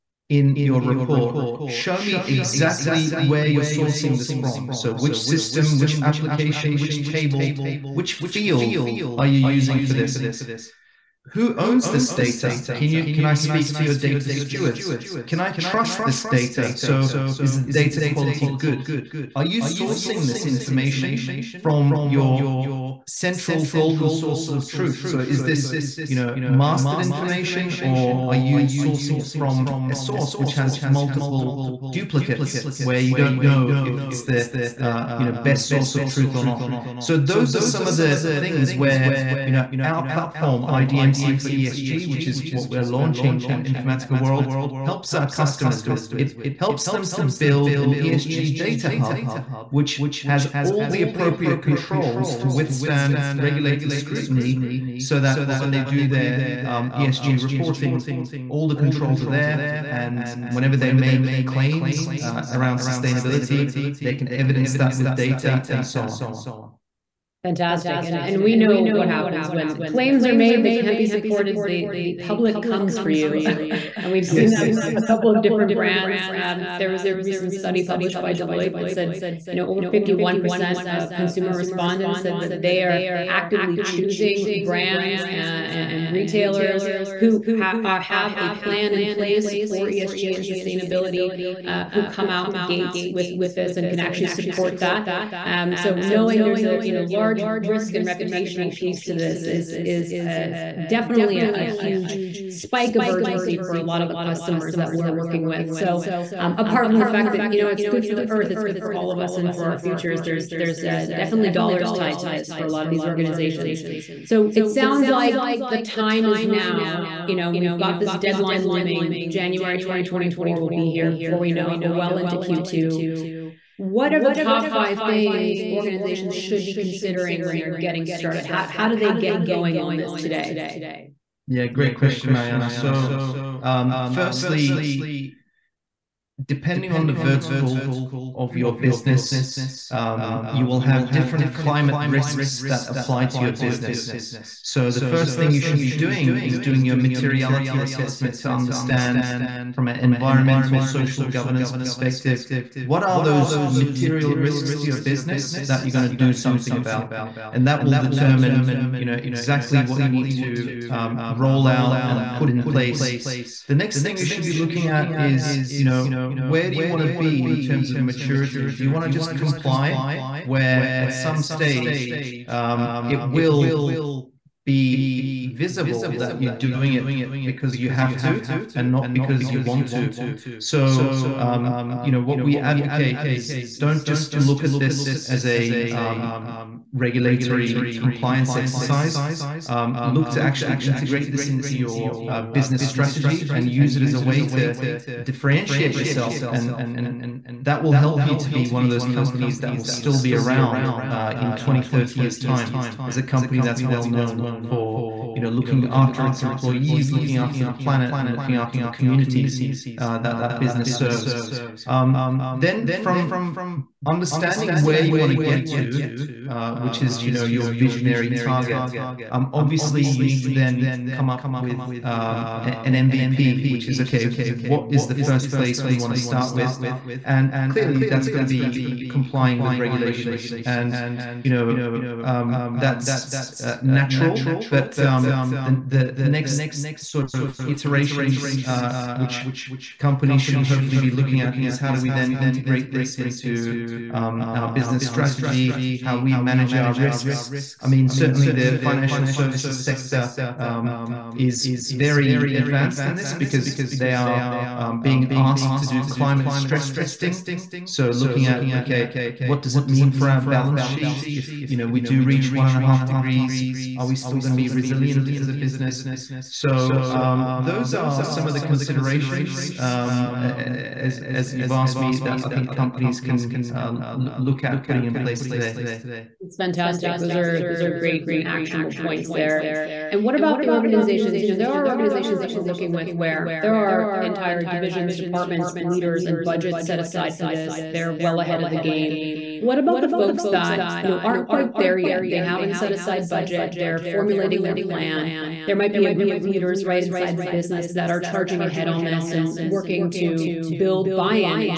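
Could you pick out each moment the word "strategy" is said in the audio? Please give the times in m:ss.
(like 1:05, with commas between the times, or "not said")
3:12, 4:05.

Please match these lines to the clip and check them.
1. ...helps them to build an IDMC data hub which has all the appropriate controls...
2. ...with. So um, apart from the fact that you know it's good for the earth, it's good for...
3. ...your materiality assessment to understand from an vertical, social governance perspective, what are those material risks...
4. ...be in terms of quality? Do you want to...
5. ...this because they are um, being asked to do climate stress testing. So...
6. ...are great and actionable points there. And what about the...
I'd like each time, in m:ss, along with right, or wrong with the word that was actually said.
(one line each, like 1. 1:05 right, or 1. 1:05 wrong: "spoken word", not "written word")
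1. 0:46 wrong: "ESG", not "IDMC"
2. 1:45 right
3. 2:26 wrong: "environmental", not "vertical"
4. 2:47 wrong: "maturity", not "quality"
5. 4:13 right
6. 4:37 right.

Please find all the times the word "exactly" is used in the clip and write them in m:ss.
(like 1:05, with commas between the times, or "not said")
0:02, 2:39.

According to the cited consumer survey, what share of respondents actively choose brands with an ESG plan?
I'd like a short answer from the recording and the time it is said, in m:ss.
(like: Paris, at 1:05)
over 51%, at 1:19.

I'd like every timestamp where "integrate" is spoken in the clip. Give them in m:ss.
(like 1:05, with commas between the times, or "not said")
3:10, 4:02.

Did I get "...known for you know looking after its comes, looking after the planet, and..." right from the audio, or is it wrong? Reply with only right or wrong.
wrong.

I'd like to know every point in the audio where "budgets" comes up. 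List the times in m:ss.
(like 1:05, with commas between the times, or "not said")
4:46, 4:53.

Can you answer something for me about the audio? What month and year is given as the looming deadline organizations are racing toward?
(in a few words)
January 2024.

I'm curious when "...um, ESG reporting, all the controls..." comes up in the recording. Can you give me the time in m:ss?
0:56.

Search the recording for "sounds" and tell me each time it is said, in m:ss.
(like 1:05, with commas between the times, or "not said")
1:54.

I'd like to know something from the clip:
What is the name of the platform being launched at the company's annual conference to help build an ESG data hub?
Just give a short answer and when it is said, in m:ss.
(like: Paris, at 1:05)
IDMC for ESG, at 0:40.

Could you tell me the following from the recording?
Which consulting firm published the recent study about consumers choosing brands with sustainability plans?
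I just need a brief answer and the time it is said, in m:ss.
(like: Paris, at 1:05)
Deloitte, at 1:18.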